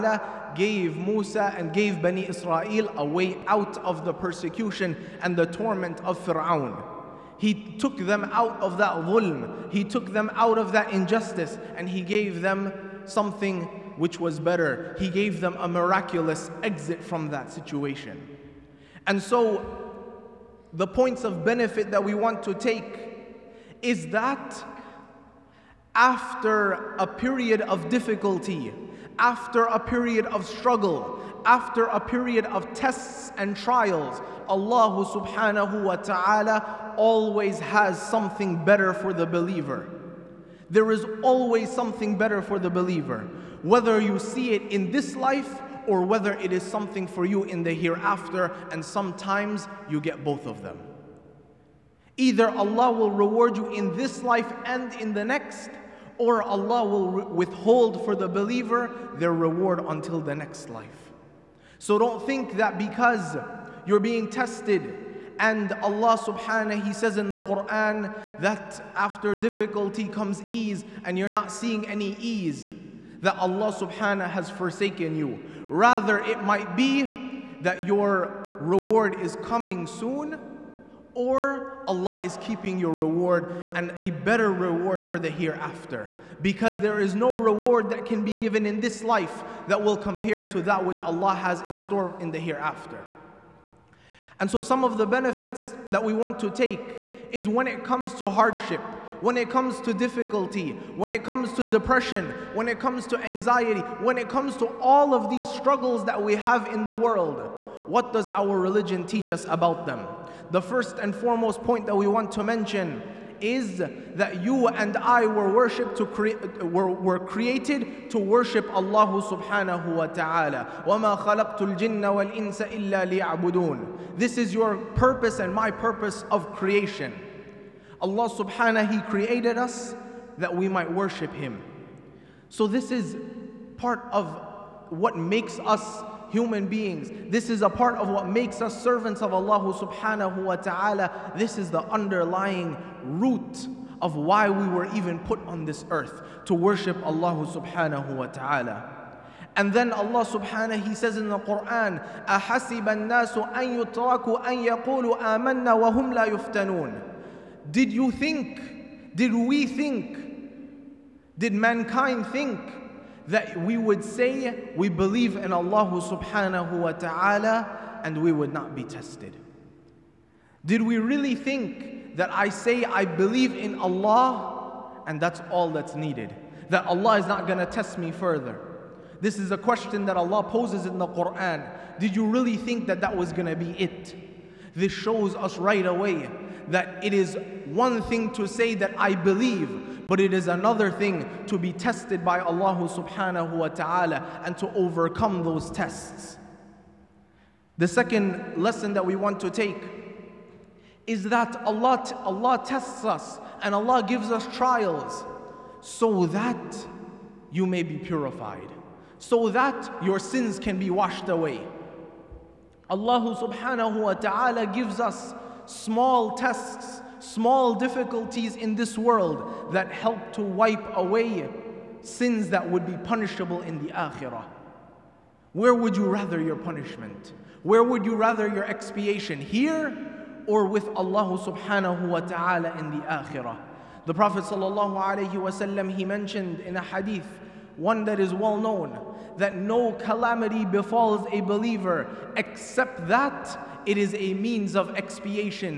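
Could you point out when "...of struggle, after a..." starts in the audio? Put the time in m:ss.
0:30.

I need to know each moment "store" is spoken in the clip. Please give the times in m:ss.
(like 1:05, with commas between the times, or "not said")
1:31.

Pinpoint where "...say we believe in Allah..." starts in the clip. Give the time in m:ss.
2:44.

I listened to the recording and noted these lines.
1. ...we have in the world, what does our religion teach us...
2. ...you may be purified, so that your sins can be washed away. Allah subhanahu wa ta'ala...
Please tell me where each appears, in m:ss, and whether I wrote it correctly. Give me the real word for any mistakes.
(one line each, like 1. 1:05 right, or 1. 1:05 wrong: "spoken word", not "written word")
1. 1:46 right
2. 3:27 right.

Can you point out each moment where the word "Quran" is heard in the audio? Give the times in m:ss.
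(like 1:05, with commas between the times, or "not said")
1:07, 2:31, 3:01.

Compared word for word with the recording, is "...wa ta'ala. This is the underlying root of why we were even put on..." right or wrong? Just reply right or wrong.
right.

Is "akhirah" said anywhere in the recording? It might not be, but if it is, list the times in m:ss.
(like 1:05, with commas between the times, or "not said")
3:43, 3:53.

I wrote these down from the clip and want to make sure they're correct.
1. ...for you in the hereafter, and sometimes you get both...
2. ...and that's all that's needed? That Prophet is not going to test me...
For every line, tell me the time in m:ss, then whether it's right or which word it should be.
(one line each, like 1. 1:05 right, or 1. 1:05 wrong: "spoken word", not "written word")
1. 0:47 right
2. 2:55 wrong: "Allah", not "Prophet".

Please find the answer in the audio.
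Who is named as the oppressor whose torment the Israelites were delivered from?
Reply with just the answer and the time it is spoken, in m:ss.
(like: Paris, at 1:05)
Fir'aun, at 0:06.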